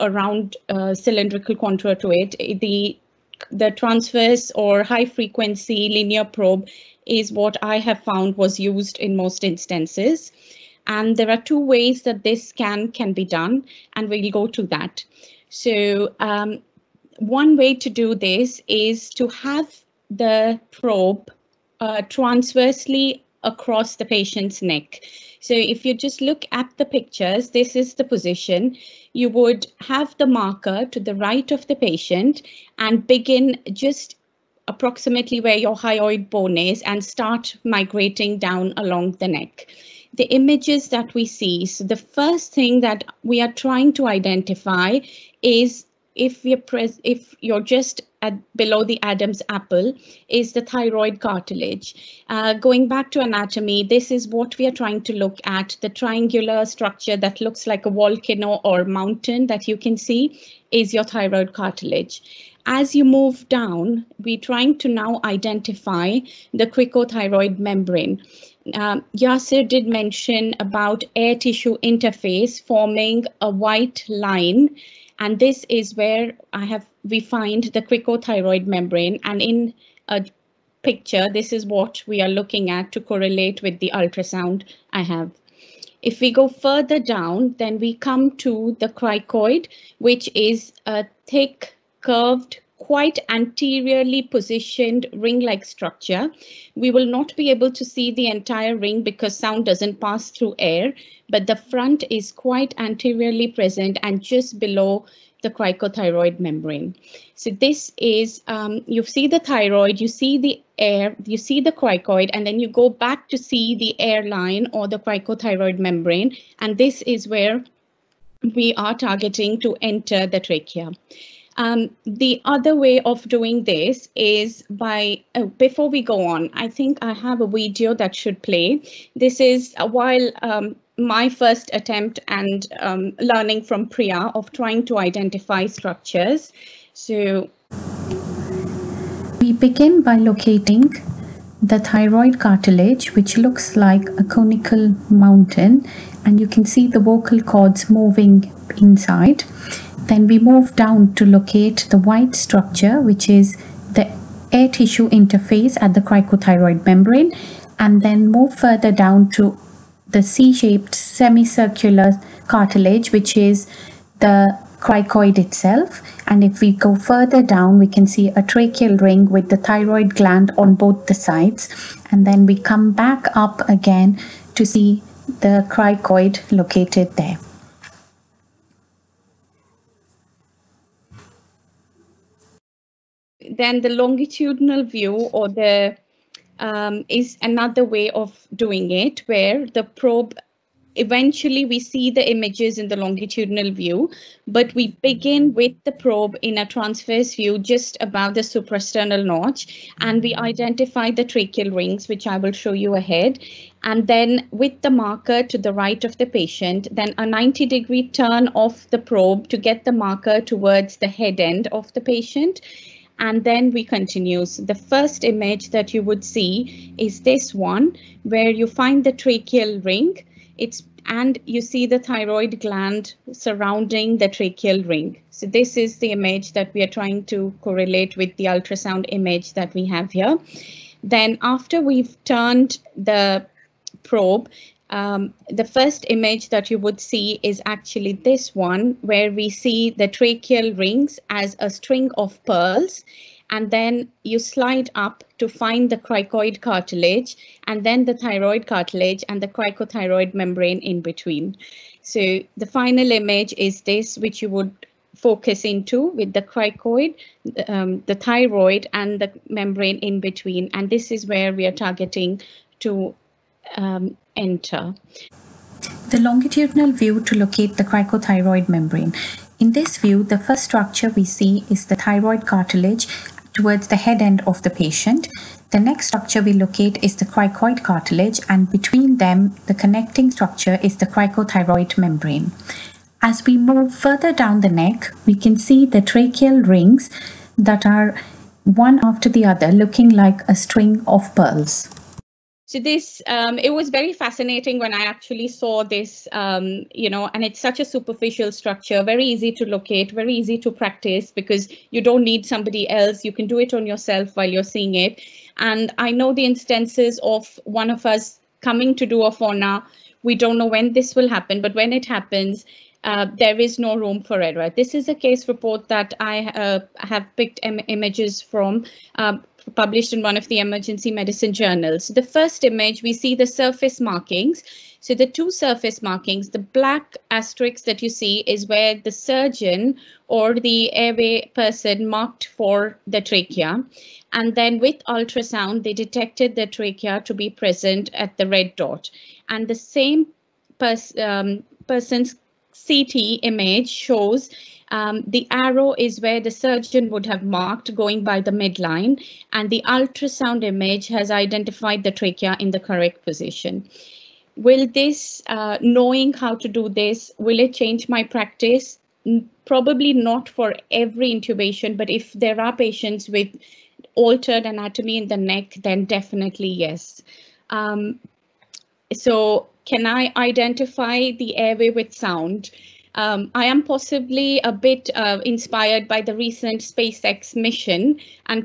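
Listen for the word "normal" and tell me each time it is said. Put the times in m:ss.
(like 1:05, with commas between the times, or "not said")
not said.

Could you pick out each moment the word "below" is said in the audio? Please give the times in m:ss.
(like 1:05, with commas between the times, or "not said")
0:48, 1:44.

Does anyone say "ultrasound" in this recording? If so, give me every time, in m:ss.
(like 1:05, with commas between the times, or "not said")
1:23, 3:48, 5:35, 5:49.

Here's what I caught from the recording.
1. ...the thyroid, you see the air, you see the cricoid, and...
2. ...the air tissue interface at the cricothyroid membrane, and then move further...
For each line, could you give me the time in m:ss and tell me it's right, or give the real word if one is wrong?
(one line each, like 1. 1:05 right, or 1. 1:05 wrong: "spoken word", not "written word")
1. 1:49 right
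2. 2:33 right.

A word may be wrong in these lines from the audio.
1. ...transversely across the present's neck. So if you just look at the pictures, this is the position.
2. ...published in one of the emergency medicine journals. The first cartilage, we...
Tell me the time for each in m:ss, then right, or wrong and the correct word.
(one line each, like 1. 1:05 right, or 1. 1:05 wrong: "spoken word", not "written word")
1. 0:22 wrong: "patient", not "present"
2. 5:19 wrong: "image", not "cartilage".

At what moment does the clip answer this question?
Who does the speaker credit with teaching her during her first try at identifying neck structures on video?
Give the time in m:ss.
2:13.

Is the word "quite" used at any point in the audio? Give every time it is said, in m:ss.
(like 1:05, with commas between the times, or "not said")
1:32, 1:42.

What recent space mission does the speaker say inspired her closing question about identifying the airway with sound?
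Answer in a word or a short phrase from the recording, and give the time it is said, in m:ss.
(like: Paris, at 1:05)
SpaceX mission, at 6:16.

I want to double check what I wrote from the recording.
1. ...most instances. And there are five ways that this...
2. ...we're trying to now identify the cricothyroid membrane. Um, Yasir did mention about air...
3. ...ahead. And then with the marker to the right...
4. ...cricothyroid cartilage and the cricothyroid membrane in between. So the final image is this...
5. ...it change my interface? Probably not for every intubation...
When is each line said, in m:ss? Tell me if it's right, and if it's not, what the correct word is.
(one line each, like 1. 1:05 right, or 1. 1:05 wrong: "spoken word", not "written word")
1. 0:09 wrong: "two", not "five"
2. 1:04 right
3. 3:22 right
4. 4:08 wrong: "thyroid", not "cricothyroid"
5. 5:57 wrong: "practice", not "interface".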